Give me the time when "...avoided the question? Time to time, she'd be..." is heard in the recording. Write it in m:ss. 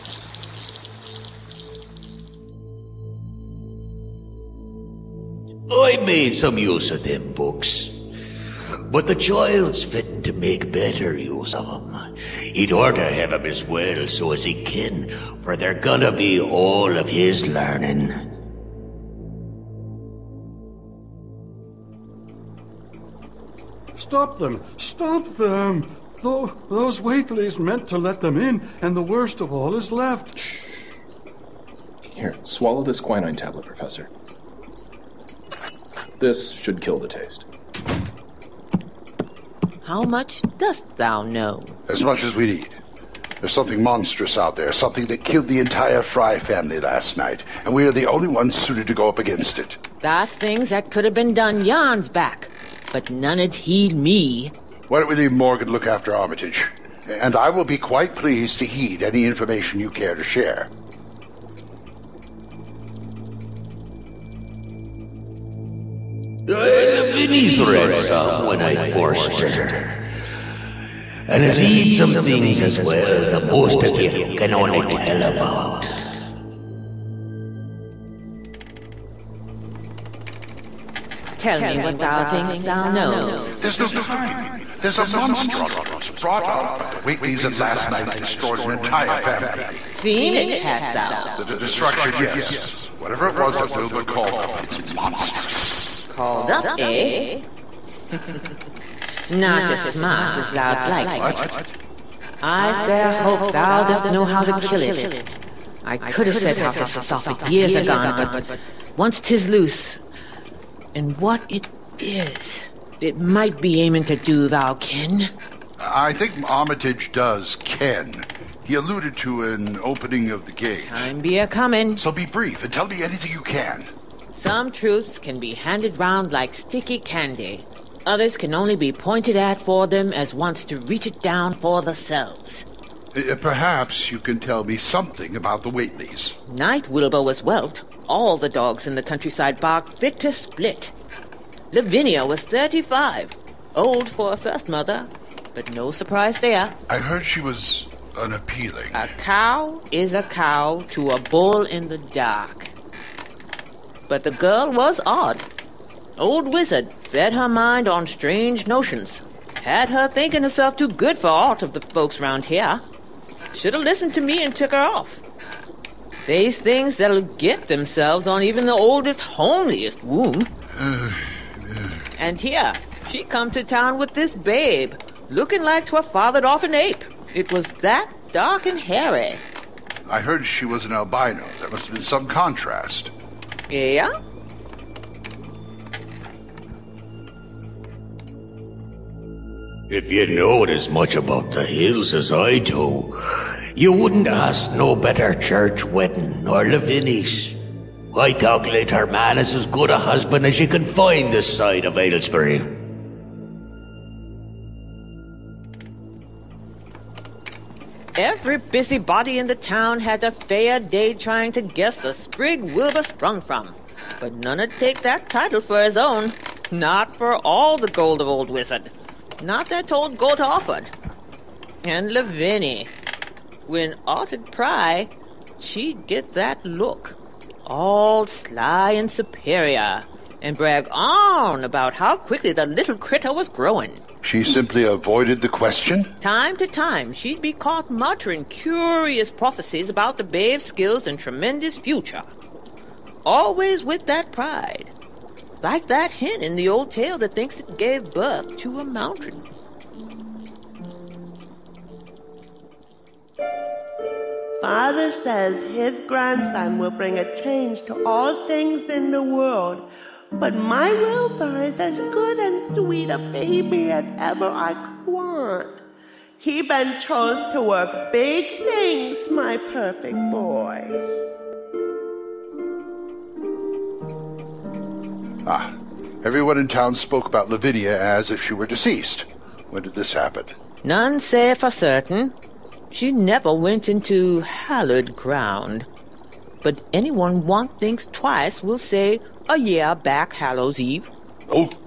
3:54.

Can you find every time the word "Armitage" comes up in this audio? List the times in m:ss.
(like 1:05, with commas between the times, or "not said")
0:56, 1:56.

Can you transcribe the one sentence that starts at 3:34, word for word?
But none'd take that title for his own, not for all the gold of old wizard not that old goat offered.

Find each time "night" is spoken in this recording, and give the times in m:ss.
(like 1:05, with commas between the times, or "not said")
0:47, 1:27, 2:16.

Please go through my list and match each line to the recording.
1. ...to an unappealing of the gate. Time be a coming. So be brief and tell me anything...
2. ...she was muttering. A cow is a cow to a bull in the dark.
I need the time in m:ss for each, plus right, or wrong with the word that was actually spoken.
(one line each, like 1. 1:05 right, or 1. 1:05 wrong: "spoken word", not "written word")
1. 1:59 wrong: "opening", not "unappealing"
2. 2:27 wrong: "unappealing", not "muttering".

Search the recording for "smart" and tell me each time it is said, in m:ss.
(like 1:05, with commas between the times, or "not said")
1:39.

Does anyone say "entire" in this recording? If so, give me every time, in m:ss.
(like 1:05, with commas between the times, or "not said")
0:45, 1:28.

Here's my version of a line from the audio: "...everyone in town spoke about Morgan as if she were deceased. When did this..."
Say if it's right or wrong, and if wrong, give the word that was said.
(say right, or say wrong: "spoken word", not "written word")
wrong: "Lavinia", not "Morgan".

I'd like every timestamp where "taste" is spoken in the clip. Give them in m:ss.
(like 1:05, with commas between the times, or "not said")
0:37.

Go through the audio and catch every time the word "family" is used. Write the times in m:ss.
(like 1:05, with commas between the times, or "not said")
0:46, 1:29.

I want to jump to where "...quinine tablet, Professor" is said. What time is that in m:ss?
0:33.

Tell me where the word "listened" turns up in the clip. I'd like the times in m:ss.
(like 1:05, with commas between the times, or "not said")
2:43.